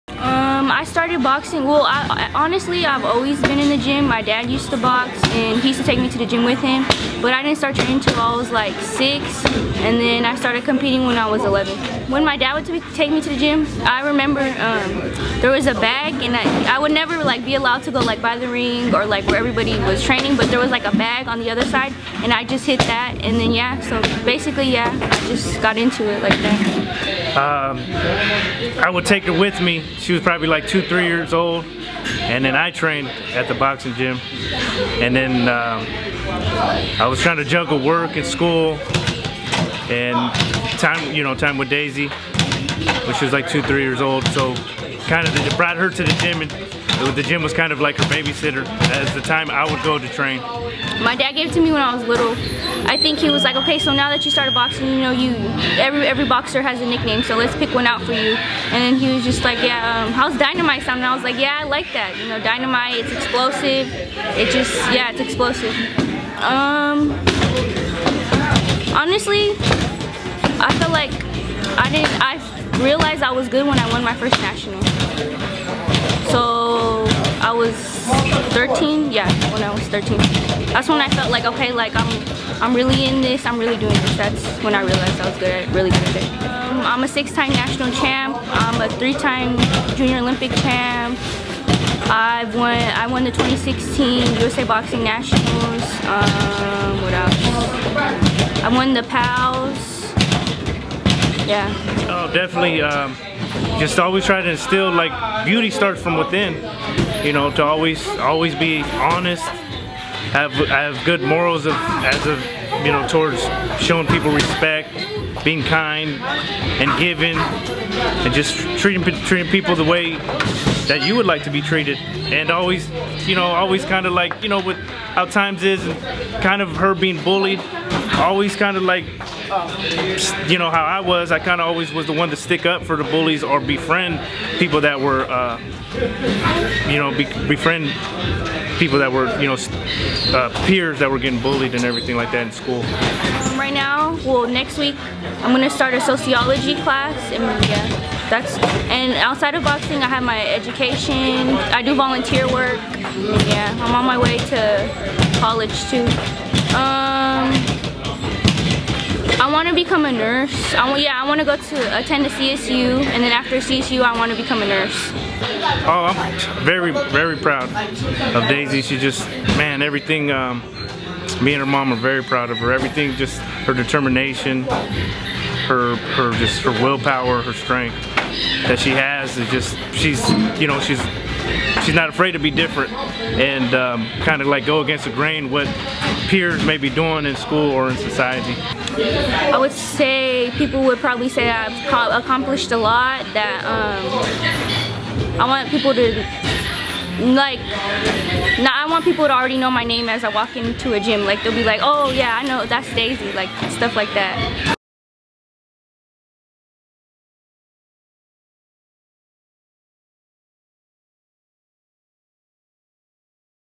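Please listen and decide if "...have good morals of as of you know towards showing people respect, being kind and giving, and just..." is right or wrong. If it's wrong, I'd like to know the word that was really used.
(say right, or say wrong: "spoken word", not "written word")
right.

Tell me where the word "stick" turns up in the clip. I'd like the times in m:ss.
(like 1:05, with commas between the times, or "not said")
2:12.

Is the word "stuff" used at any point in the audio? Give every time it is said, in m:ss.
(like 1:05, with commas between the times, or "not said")
3:23.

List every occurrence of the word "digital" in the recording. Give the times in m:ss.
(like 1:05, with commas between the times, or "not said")
not said.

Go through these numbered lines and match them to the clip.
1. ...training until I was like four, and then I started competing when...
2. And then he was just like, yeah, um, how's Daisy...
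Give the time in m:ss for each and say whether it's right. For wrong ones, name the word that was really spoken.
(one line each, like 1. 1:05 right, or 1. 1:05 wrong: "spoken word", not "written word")
1. 0:07 wrong: "six", not "four"
2. 0:58 wrong: "Dynamite", not "Daisy".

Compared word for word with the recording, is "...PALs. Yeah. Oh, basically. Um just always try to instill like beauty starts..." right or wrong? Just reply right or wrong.
wrong.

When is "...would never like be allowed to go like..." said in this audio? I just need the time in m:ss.
0:16.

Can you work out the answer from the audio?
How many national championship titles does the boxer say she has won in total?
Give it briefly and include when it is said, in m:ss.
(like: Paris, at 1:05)
6, at 1:27.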